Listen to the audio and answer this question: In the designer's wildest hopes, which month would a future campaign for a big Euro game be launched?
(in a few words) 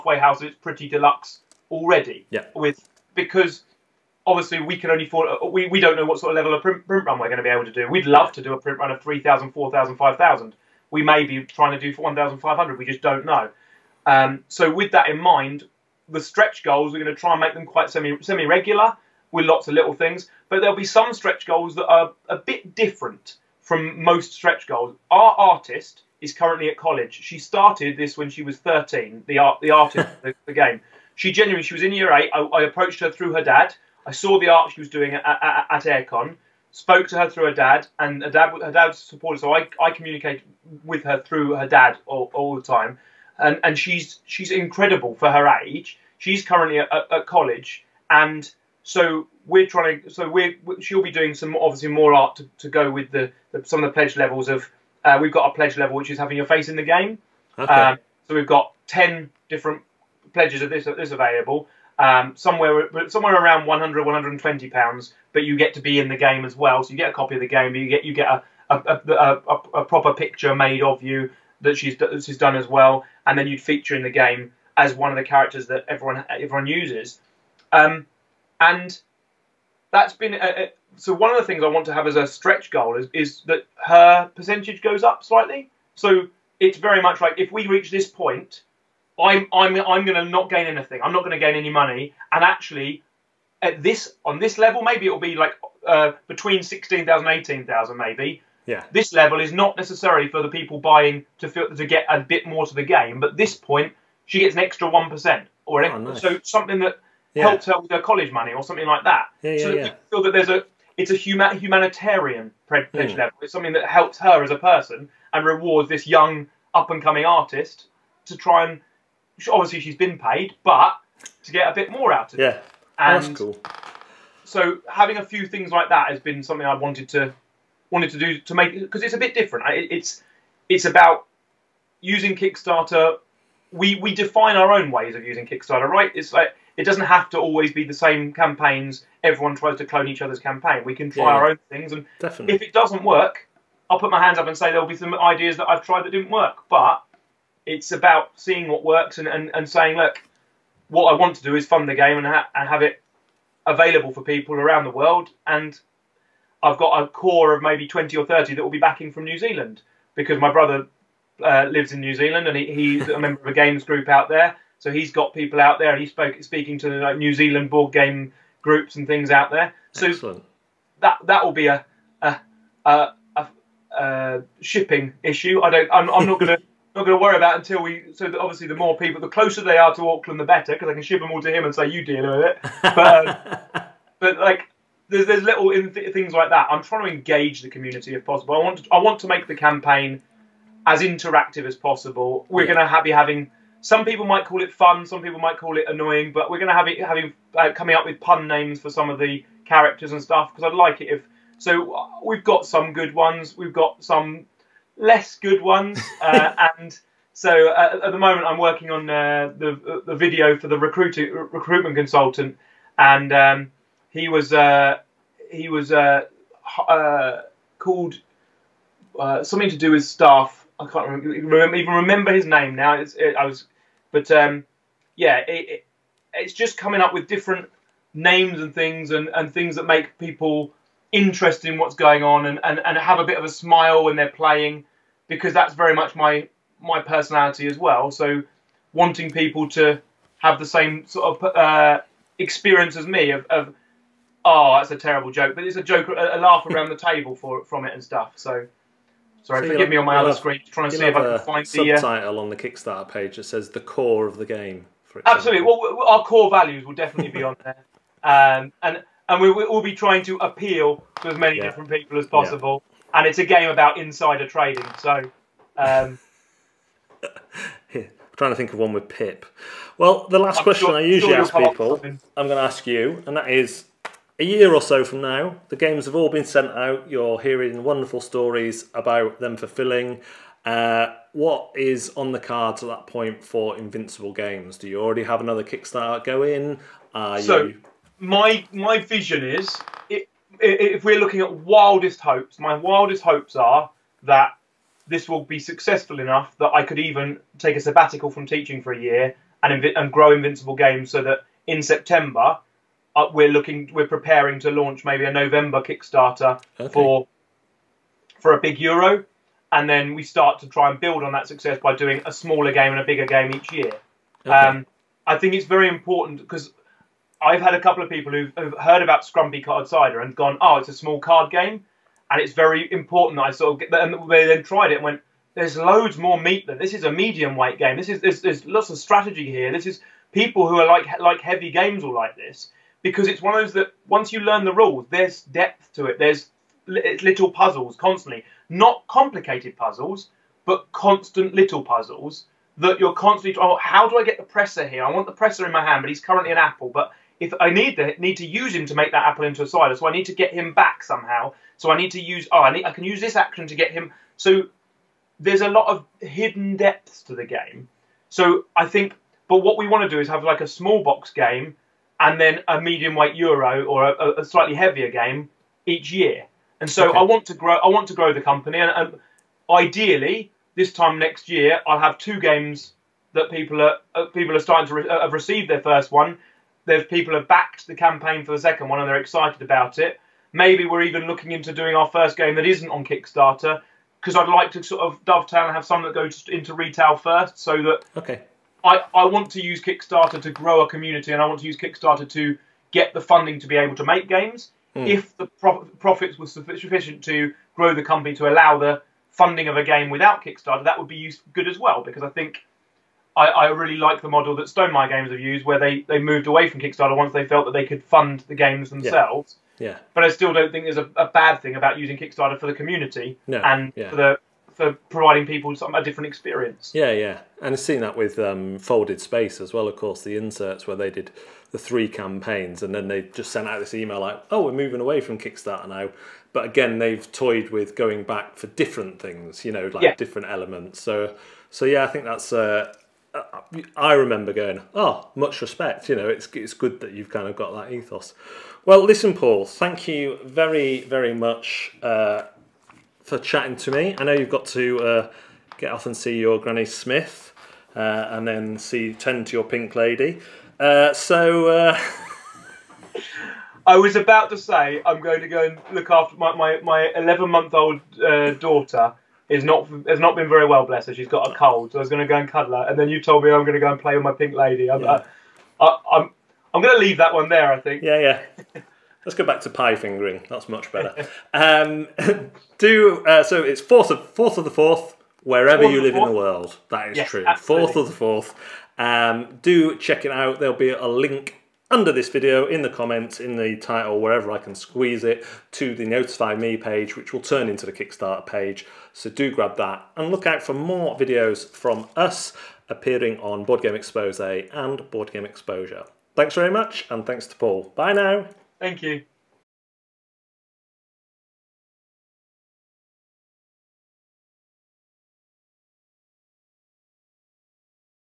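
November.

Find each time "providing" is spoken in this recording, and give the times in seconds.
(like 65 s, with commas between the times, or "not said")
415 s.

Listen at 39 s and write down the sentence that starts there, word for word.
So I, I communicate with her through her dad all, all the time, and and she's she's incredible for her age.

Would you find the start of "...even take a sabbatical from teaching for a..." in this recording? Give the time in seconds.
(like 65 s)
296 s.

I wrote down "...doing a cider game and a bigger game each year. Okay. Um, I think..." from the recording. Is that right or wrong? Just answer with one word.
wrong.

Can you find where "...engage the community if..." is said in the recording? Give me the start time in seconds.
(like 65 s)
187 s.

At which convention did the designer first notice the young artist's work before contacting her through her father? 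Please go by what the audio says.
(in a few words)
AireCon.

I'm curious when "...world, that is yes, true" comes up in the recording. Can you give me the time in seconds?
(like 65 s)
476 s.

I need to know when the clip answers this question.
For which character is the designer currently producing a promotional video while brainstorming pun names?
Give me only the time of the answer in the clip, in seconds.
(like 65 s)
211 s.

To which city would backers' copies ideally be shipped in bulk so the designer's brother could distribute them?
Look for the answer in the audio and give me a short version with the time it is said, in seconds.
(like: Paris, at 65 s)
Auckland, at 180 s.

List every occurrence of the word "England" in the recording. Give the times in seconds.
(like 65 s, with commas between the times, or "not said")
not said.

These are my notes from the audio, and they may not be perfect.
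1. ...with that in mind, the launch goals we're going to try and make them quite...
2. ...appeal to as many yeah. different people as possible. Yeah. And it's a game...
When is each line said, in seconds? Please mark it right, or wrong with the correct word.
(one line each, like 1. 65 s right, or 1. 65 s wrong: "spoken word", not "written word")
1. 14 s wrong: "stretch", not "launch"
2. 260 s right.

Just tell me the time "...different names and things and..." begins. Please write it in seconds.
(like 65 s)
227 s.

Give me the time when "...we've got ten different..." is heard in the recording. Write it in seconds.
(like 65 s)
58 s.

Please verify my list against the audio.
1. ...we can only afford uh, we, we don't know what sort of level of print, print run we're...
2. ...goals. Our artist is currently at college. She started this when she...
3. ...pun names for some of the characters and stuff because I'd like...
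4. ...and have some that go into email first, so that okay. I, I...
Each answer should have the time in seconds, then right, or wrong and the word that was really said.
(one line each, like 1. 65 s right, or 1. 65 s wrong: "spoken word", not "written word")
1. 4 s right
2. 24 s right
3. 198 s right
4. 385 s wrong: "retail", not "email".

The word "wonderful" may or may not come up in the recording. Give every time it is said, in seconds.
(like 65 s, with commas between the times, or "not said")
277 s.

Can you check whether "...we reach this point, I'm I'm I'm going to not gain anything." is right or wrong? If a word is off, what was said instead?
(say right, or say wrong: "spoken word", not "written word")
right.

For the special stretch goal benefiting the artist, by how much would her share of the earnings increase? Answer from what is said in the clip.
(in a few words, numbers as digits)
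1 percent.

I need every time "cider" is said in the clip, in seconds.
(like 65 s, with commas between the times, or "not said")
319 s, 349 s.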